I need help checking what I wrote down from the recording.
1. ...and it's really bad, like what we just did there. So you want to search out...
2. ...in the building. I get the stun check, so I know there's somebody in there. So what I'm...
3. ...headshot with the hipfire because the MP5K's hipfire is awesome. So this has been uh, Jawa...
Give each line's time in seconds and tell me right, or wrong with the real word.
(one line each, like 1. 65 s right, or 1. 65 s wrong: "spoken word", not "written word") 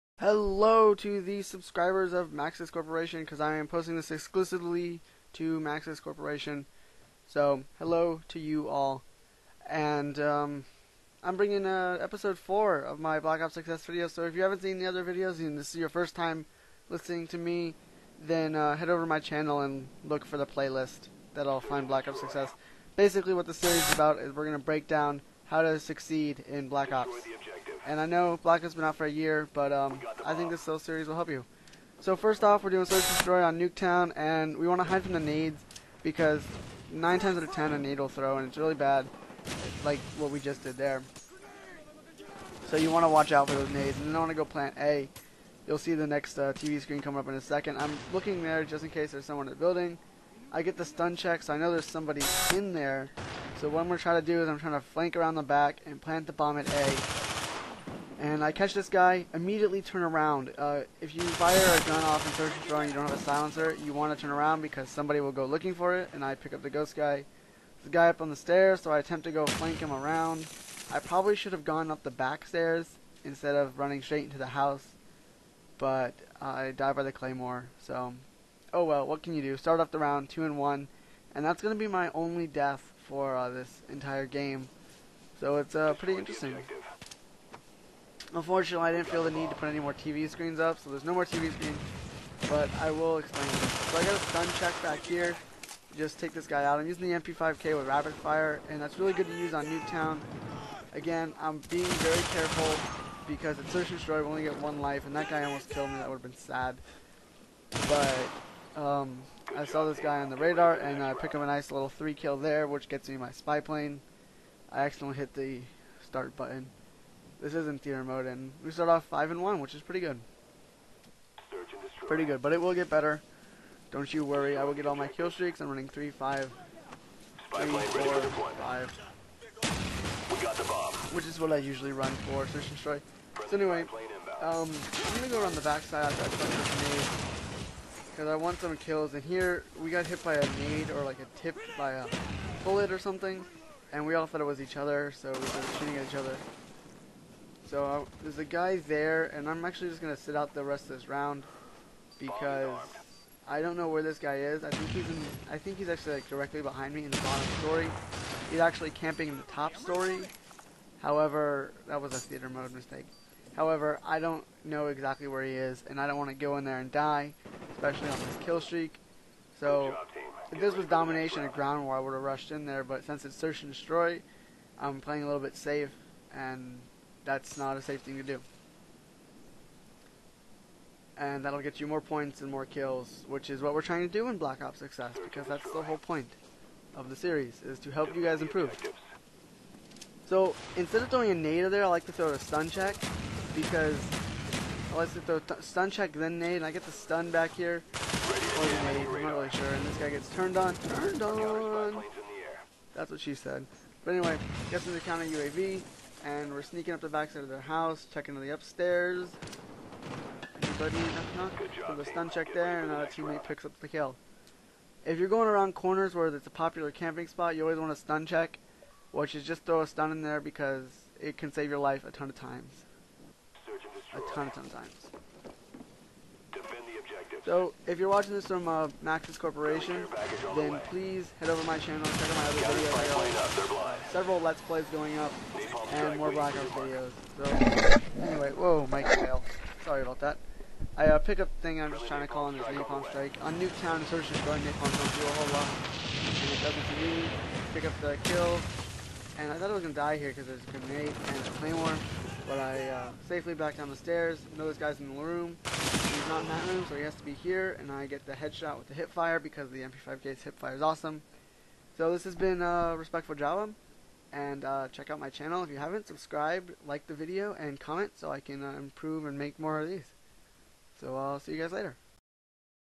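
1. 38 s wrong: "watch", not "search"
2. 49 s right
3. 258 s wrong: "Respectful", not "Jawa".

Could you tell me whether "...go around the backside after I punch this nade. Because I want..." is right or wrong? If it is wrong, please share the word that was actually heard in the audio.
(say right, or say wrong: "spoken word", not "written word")
right.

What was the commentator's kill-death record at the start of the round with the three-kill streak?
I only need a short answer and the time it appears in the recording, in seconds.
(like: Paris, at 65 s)
5 and 1, at 119 s.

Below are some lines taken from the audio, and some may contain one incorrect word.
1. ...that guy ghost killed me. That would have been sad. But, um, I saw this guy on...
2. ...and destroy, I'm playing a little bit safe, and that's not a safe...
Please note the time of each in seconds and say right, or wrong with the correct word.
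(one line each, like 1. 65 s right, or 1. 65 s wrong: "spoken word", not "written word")
1. 105 s wrong: "almost", not "ghost"
2. 173 s right.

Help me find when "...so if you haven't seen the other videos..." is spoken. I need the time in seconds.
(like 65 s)
14 s.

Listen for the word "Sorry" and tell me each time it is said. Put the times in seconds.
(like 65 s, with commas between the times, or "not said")
239 s.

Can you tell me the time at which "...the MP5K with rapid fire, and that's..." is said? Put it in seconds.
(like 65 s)
97 s.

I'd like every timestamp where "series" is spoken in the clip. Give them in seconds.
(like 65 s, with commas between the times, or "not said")
23 s, 30 s, 187 s.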